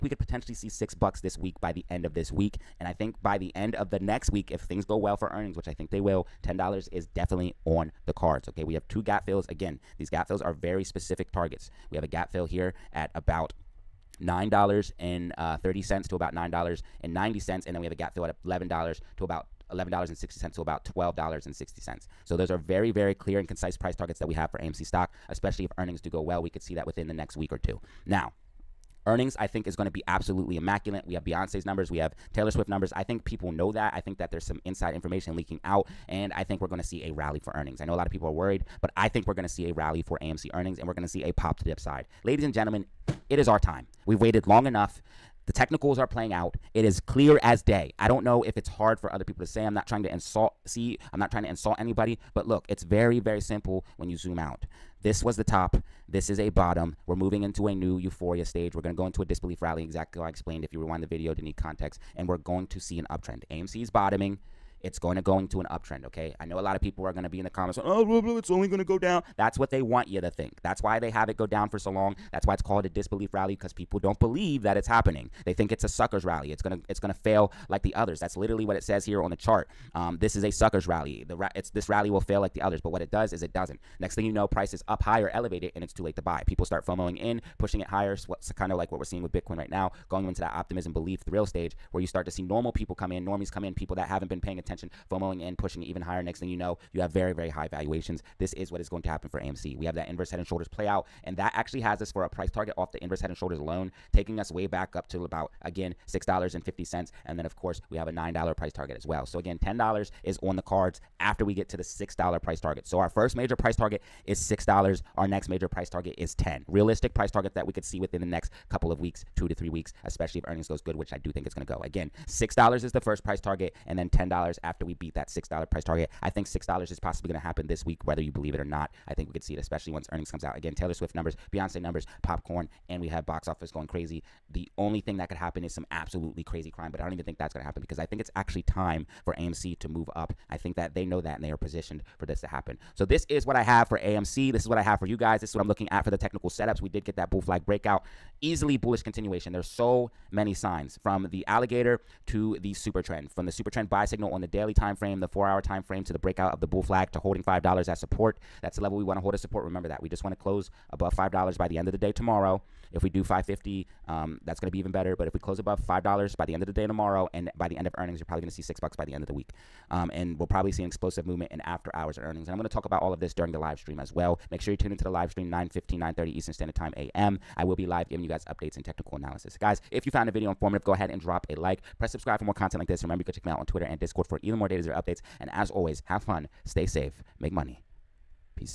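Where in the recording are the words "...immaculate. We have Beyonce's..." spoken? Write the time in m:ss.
0:30.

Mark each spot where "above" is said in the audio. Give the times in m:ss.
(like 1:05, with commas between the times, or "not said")
2:40, 2:45.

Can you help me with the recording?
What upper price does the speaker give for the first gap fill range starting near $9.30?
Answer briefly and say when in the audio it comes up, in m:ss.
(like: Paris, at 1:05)
$9.90, at 0:16.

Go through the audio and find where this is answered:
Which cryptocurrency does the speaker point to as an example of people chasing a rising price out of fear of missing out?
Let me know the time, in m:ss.
1:29.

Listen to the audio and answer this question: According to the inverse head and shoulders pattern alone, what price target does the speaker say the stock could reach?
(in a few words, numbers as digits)
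$6.50.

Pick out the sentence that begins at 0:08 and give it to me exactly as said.
Okay, we have two gap fills again.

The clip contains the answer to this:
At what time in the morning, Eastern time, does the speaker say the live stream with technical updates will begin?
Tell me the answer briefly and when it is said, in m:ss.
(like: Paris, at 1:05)
9:15, at 2:55.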